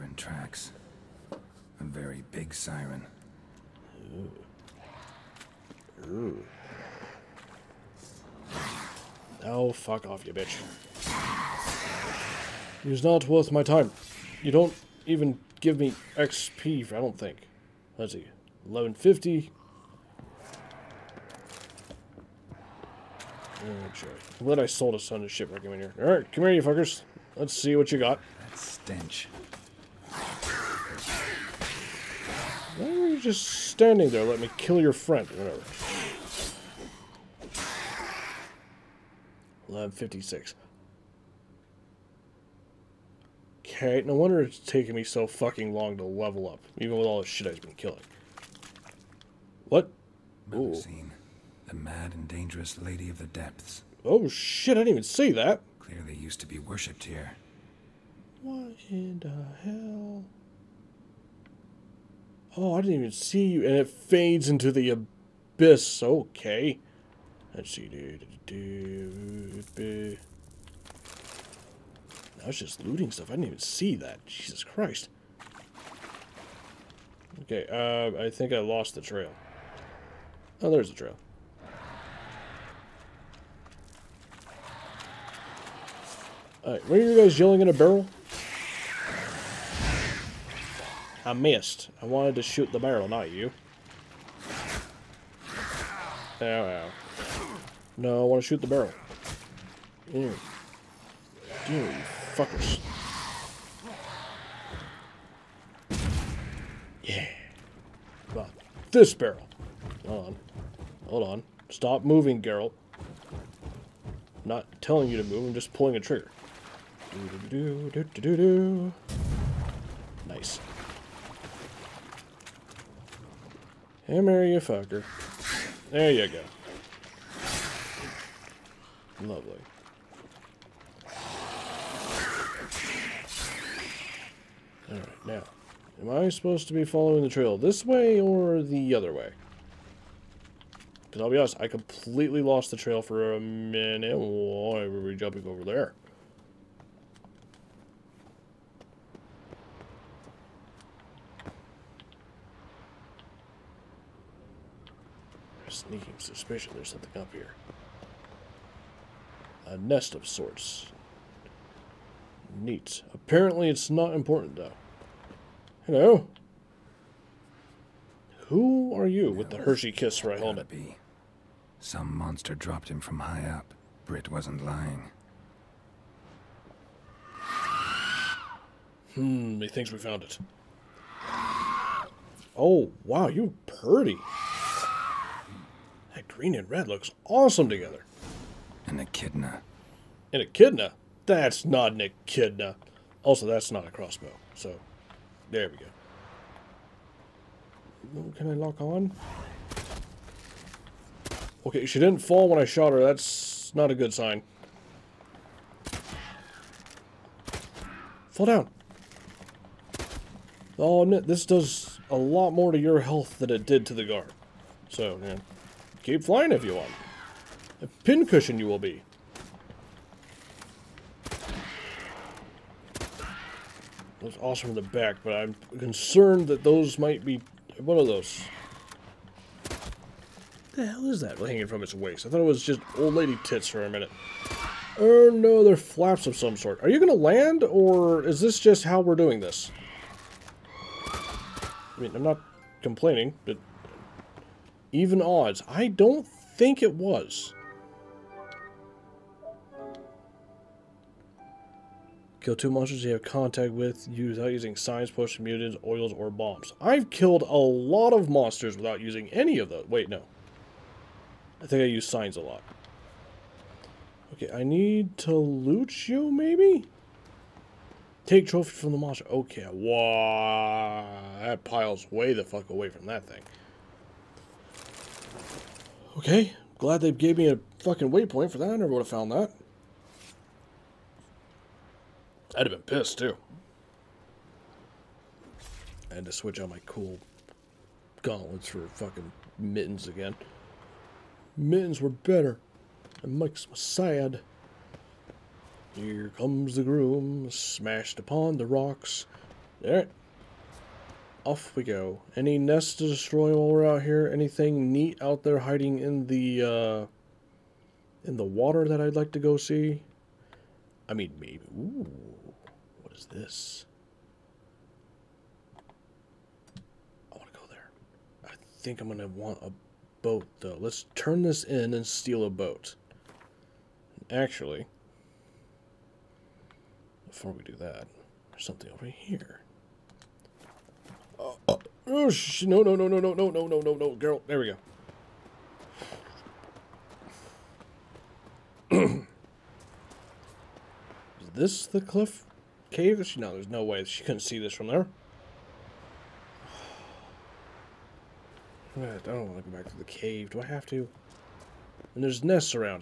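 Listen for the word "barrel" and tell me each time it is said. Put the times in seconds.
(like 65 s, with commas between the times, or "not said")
87 s, 92 s, 98 s, 109 s.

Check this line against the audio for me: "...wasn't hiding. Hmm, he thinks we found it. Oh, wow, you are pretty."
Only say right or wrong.
wrong.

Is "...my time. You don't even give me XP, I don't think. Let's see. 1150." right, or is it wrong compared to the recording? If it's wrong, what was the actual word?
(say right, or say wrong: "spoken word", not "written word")
right.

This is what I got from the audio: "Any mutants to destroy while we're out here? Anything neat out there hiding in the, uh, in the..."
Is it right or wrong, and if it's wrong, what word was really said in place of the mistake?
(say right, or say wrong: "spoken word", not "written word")
wrong: "nests", not "mutants".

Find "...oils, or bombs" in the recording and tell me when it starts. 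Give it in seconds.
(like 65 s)
255 s.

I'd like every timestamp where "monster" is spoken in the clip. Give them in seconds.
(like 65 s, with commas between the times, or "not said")
172 s, 252 s, 258 s, 268 s.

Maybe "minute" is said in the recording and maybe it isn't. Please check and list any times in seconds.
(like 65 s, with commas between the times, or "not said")
143 s, 233 s.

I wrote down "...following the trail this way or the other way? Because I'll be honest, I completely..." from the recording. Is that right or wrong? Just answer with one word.
right.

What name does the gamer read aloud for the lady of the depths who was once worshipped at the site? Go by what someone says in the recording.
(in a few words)
Melusine.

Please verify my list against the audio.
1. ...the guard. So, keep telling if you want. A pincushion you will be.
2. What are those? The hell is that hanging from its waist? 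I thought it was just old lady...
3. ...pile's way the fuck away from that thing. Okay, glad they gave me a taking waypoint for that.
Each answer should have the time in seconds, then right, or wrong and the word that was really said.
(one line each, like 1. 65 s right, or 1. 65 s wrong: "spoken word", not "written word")
1. 213 s wrong: "flying", not "telling"
2. 227 s right
3. 271 s wrong: "fucking", not "taking".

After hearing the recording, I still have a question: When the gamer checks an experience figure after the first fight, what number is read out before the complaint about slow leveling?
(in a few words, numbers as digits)
1156.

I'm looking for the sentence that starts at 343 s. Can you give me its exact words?
She, no, there's no way she couldn't see this from there.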